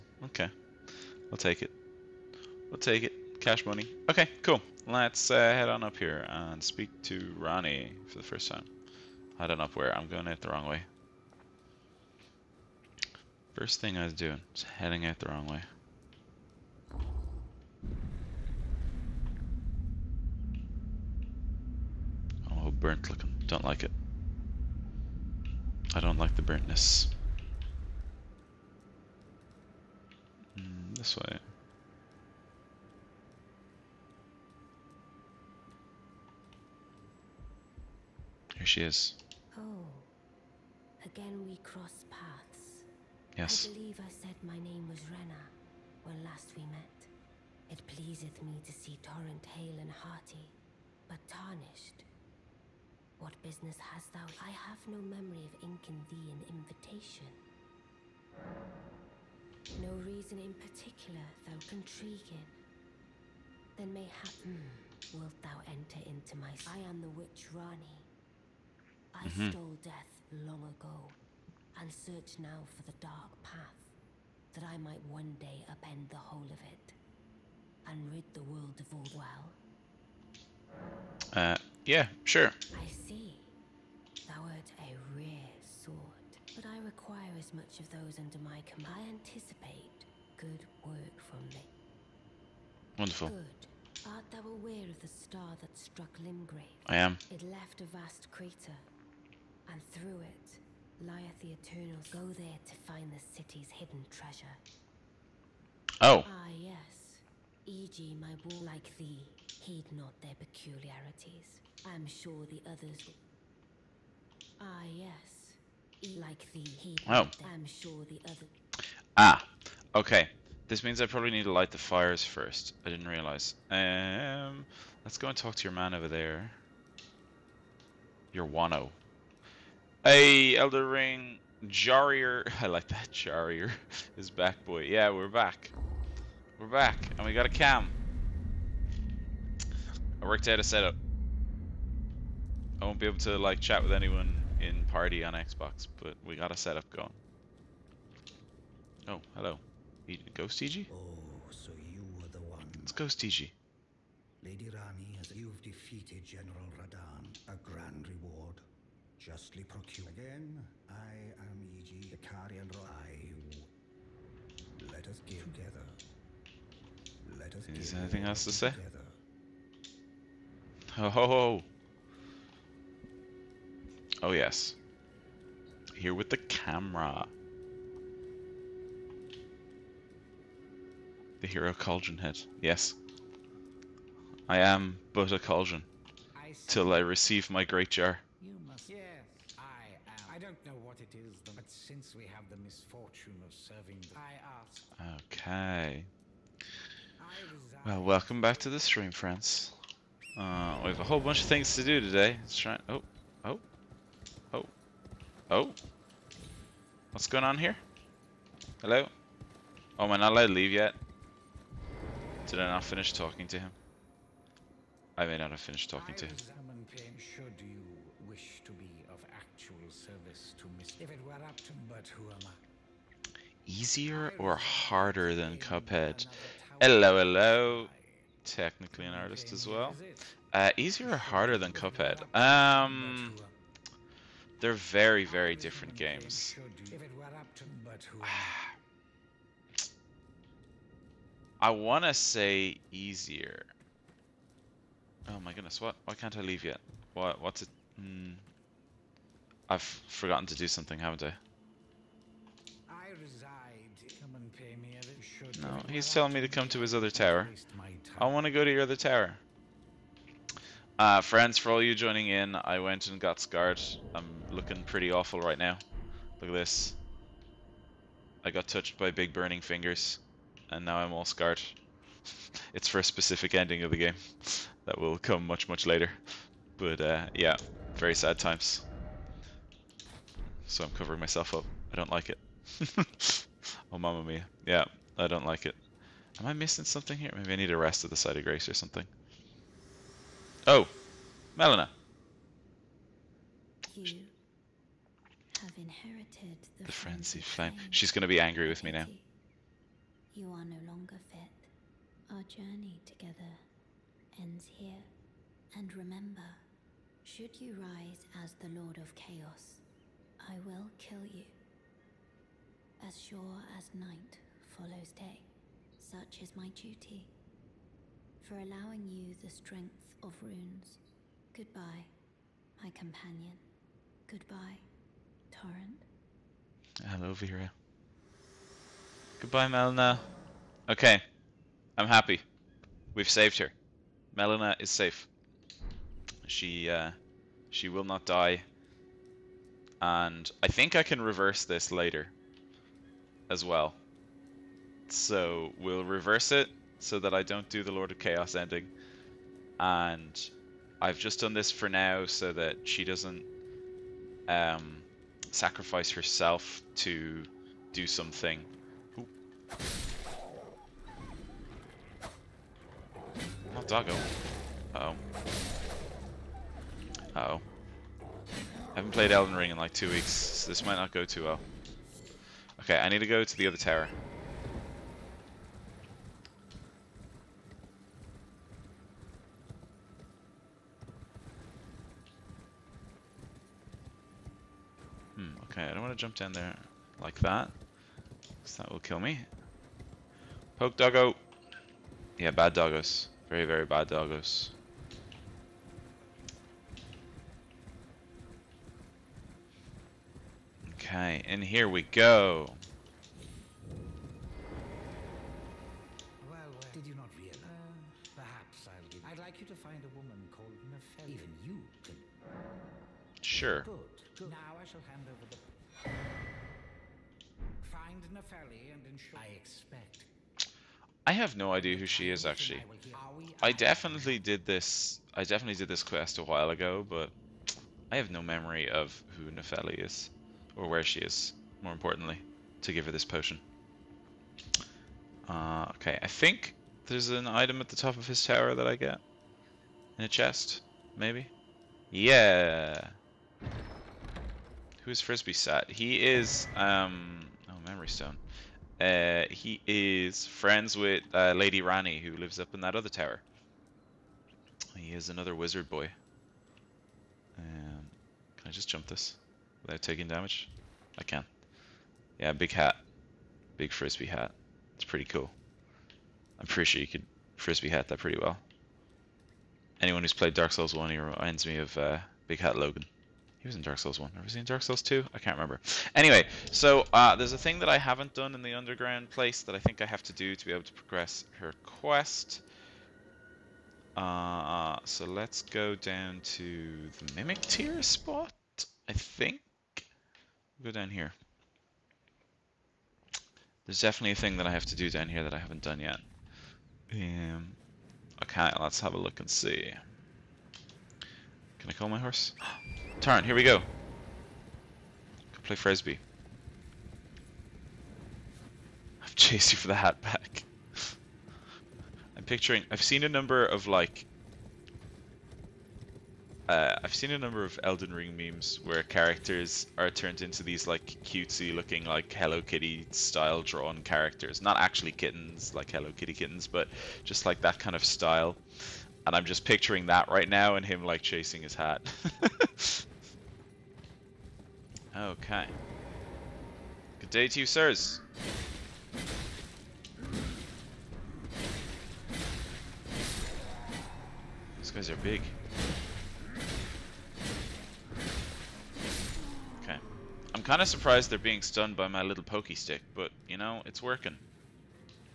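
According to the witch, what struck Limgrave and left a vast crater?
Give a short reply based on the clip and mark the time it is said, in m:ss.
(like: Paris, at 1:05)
The star, at 1:35.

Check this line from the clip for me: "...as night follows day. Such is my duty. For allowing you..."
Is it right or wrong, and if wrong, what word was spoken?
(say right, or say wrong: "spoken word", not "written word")
right.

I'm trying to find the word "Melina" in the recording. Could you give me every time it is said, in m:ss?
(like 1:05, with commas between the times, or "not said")
4:51, 5:29, 5:34.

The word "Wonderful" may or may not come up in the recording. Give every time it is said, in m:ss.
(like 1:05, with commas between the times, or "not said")
1:32.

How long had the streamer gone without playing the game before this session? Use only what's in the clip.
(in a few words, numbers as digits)
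2 weeks.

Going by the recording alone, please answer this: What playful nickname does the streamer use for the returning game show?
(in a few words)
Elder Ring Jarrier.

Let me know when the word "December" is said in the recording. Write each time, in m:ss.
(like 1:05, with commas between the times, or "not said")
not said.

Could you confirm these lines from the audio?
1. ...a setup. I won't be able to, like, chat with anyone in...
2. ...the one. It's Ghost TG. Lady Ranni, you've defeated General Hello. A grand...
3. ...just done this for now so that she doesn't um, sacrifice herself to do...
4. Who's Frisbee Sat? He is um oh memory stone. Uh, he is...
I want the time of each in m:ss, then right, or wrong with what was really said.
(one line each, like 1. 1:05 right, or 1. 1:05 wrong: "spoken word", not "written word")
1. 2:20 right
2. 2:32 wrong: "Radahn", not "Hello"
3. 5:51 right
4. 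7:25 right.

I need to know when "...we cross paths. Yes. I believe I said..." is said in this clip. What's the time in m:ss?
0:41.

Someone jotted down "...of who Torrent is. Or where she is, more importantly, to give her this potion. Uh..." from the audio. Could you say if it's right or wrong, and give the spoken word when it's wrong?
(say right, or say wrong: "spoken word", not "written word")
wrong: "Nepheli", not "Torrent".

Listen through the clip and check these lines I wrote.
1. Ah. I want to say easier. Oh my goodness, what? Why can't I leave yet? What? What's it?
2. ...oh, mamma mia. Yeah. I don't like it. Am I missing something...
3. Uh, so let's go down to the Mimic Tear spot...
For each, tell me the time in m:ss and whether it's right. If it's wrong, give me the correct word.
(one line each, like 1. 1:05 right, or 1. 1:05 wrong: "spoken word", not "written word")
1. 3:58 right
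2. 4:43 right
3. 8:04 right.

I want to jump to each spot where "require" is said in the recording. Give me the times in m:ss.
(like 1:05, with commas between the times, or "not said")
1:26.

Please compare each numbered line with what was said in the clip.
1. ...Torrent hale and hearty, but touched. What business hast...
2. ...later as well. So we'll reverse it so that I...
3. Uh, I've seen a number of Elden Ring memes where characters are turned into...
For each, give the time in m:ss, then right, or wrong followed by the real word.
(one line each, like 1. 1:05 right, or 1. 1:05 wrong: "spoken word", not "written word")
1. 0:49 wrong: "tarnished", not "touched"
2. 5:41 right
3. 8:36 right.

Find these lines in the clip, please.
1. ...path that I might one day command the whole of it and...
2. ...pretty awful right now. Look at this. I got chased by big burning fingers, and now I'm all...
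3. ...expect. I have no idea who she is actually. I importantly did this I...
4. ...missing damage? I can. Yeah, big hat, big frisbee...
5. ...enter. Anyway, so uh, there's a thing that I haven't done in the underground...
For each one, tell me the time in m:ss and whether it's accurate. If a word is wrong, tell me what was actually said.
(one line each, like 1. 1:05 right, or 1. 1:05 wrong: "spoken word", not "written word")
1. 1:13 wrong: "upend", not "command"
2. 4:24 wrong: "touched", not "chased"
3. 6:59 wrong: "definitely", not "importantly"
4. 7:40 wrong: "taking", not "missing"
5. 7:55 wrong: "remember", not "enter".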